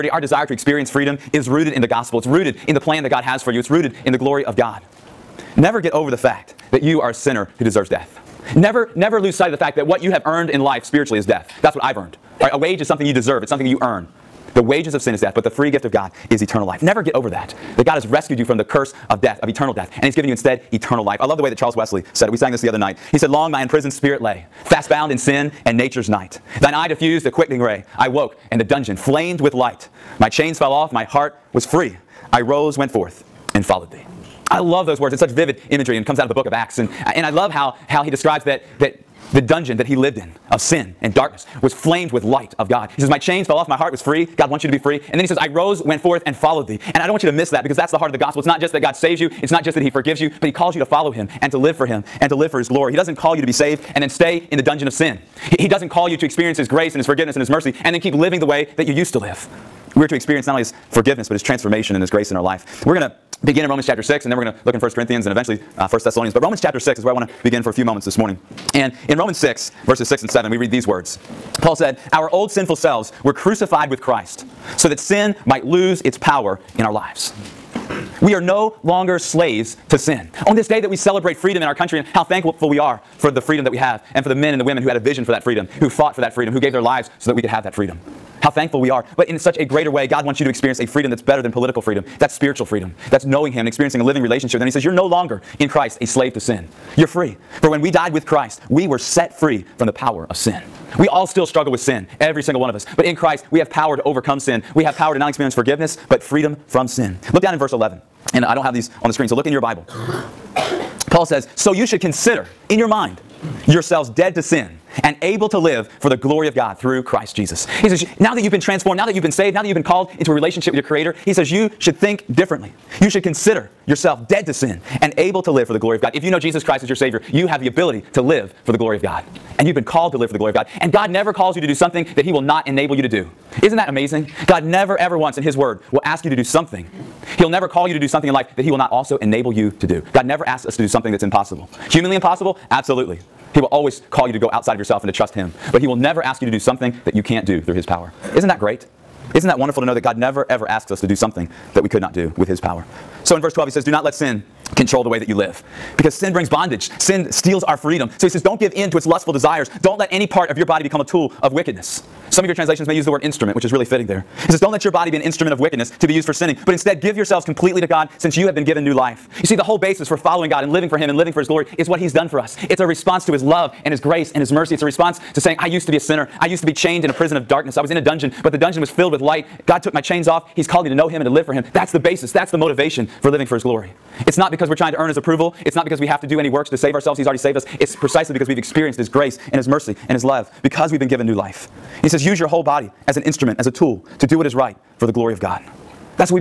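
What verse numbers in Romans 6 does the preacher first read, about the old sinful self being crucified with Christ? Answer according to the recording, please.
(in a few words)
6 and 7.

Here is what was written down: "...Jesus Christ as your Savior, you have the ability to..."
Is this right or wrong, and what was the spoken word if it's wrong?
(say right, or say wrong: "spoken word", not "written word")
right.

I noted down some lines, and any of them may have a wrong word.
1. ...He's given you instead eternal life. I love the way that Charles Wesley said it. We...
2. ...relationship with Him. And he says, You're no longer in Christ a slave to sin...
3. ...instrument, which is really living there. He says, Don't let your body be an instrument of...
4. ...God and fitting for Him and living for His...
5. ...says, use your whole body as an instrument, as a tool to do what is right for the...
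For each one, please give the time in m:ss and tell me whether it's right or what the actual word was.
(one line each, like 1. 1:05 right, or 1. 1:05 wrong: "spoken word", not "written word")
1. 0:20 right
2. 1:34 right
3. 2:43 wrong: "fitting", not "living"
4. 2:50 wrong: "living", not "fitting"
5. 3:12 right.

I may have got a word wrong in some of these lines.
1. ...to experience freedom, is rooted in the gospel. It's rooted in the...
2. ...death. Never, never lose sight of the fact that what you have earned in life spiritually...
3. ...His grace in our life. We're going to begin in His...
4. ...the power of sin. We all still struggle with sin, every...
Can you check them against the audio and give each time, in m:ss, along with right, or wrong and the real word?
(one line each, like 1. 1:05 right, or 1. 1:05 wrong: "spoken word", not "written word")
1. 0:00 right
2. 0:07 right
3. 1:02 wrong: "Romans", not "His"
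4. 1:39 right.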